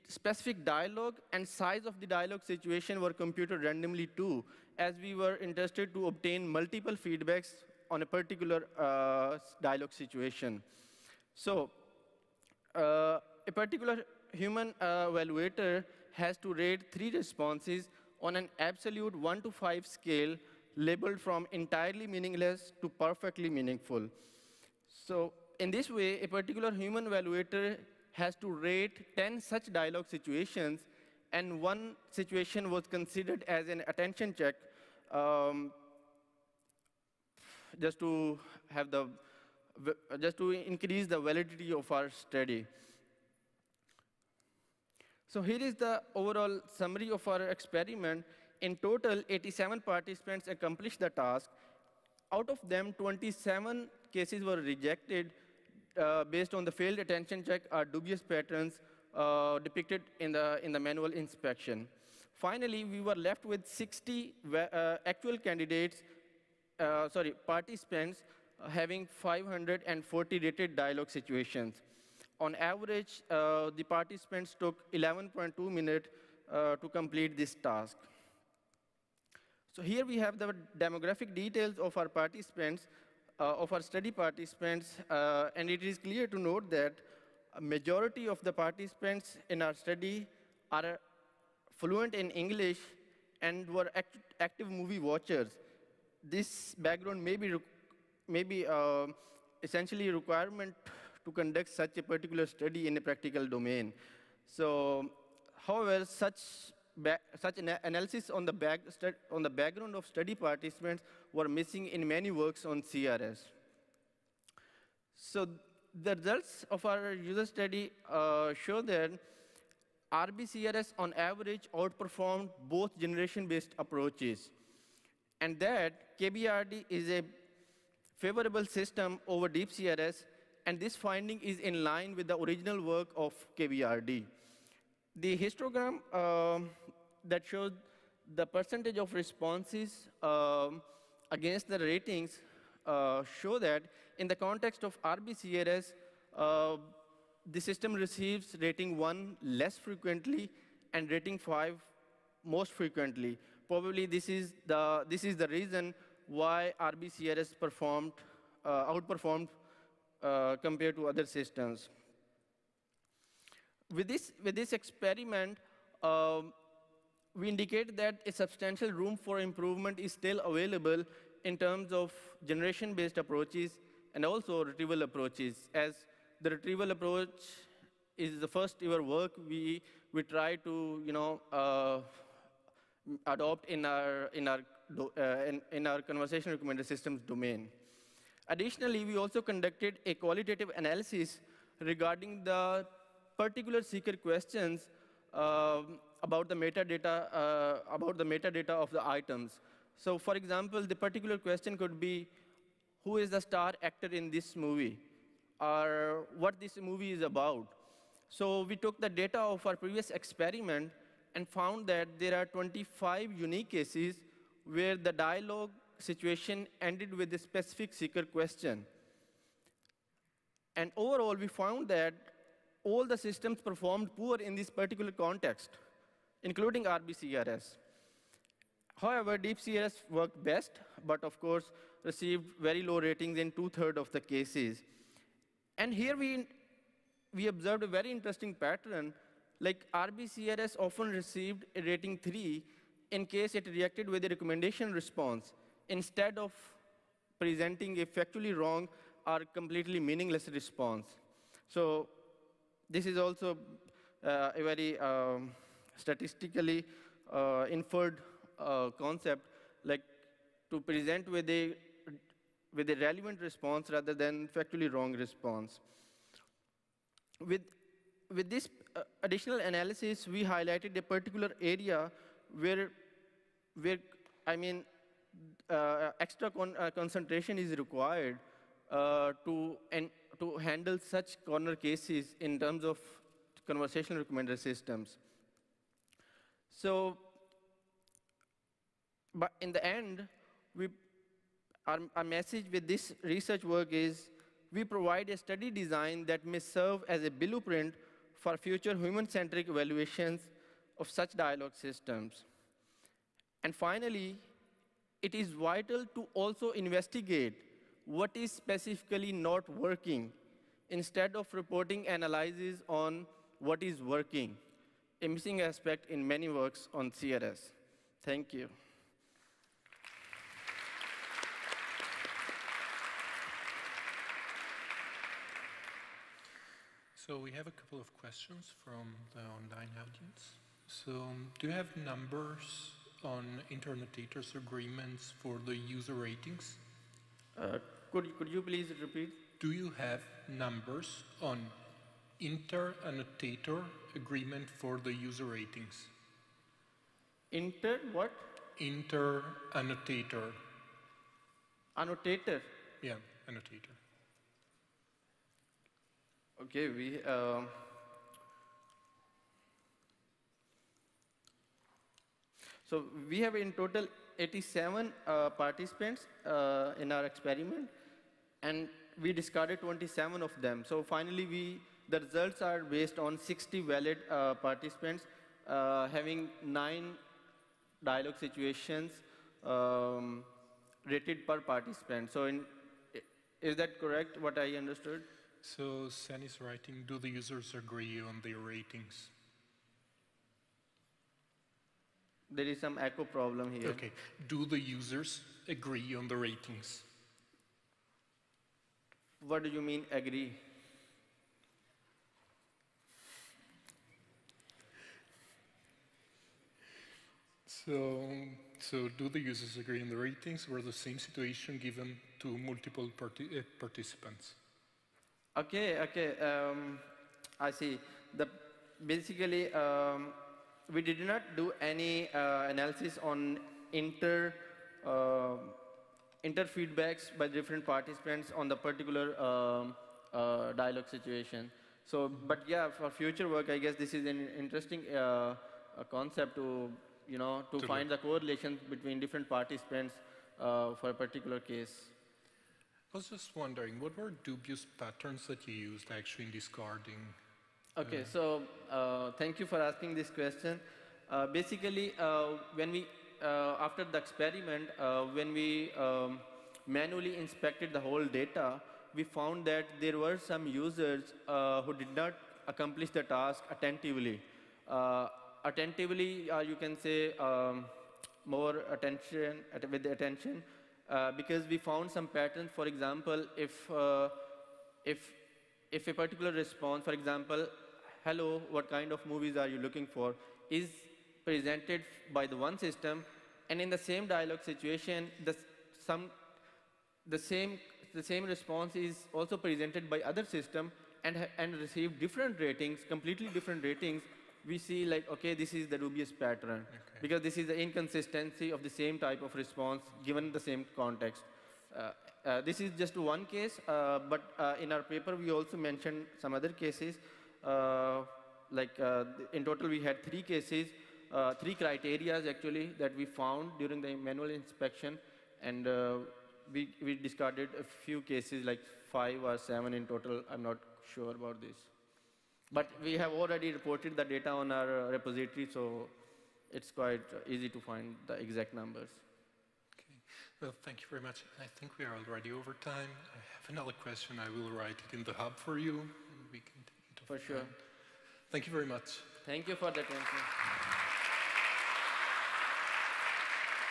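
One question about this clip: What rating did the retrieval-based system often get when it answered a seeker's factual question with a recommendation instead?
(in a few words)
3.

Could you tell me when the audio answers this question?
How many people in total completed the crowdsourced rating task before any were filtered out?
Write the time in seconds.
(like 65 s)
49 s.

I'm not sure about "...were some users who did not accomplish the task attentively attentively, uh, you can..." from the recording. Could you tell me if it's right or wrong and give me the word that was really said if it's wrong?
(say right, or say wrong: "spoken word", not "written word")
right.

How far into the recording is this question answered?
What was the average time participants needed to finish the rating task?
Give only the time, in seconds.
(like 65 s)
74 s.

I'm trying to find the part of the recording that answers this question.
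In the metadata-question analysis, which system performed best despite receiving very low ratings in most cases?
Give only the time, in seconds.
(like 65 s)
229 s.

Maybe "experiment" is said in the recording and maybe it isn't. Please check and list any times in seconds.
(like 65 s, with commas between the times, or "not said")
47 s, 164 s, 210 s, 367 s, 454 s.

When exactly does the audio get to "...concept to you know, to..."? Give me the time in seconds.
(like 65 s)
436 s.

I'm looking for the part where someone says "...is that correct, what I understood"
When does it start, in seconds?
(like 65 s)
383 s.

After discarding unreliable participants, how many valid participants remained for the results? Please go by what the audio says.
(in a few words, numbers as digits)
60.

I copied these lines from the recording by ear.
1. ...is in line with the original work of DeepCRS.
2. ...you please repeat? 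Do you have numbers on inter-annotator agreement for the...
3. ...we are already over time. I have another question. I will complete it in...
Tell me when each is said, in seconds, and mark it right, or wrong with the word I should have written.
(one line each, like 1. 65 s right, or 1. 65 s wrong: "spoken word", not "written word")
1. 131 s wrong: "KBRD", not "DeepCRS"
2. 338 s right
3. 531 s wrong: "write", not "complete".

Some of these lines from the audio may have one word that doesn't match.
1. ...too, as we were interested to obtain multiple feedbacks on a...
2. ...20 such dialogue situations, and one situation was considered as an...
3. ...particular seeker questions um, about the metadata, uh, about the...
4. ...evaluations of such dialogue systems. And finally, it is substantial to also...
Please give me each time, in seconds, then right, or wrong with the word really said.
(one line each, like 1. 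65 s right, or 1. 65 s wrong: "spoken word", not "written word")
1. 4 s right
2. 29 s wrong: "10", not "20"
3. 193 s right
4. 299 s wrong: "vital", not "substantial".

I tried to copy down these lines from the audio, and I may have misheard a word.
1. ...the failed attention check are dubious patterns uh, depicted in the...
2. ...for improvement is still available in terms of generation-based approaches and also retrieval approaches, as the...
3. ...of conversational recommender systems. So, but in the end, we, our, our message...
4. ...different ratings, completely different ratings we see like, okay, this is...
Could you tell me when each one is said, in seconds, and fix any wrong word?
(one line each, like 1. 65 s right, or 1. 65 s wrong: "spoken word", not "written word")
1. 56 s right
2. 169 s right
3. 282 s right
4. 492 s right.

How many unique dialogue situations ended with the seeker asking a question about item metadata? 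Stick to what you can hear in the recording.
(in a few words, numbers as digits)
25.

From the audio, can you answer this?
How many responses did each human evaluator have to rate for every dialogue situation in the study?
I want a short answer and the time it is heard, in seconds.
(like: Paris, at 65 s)
3, at 16 s.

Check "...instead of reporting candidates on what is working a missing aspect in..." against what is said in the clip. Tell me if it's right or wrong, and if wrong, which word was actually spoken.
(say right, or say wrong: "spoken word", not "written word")
wrong: "analyses", not "candidates".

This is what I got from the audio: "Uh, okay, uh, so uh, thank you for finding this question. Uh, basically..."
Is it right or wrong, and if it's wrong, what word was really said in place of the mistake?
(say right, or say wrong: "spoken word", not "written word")
wrong: "asking", not "finding".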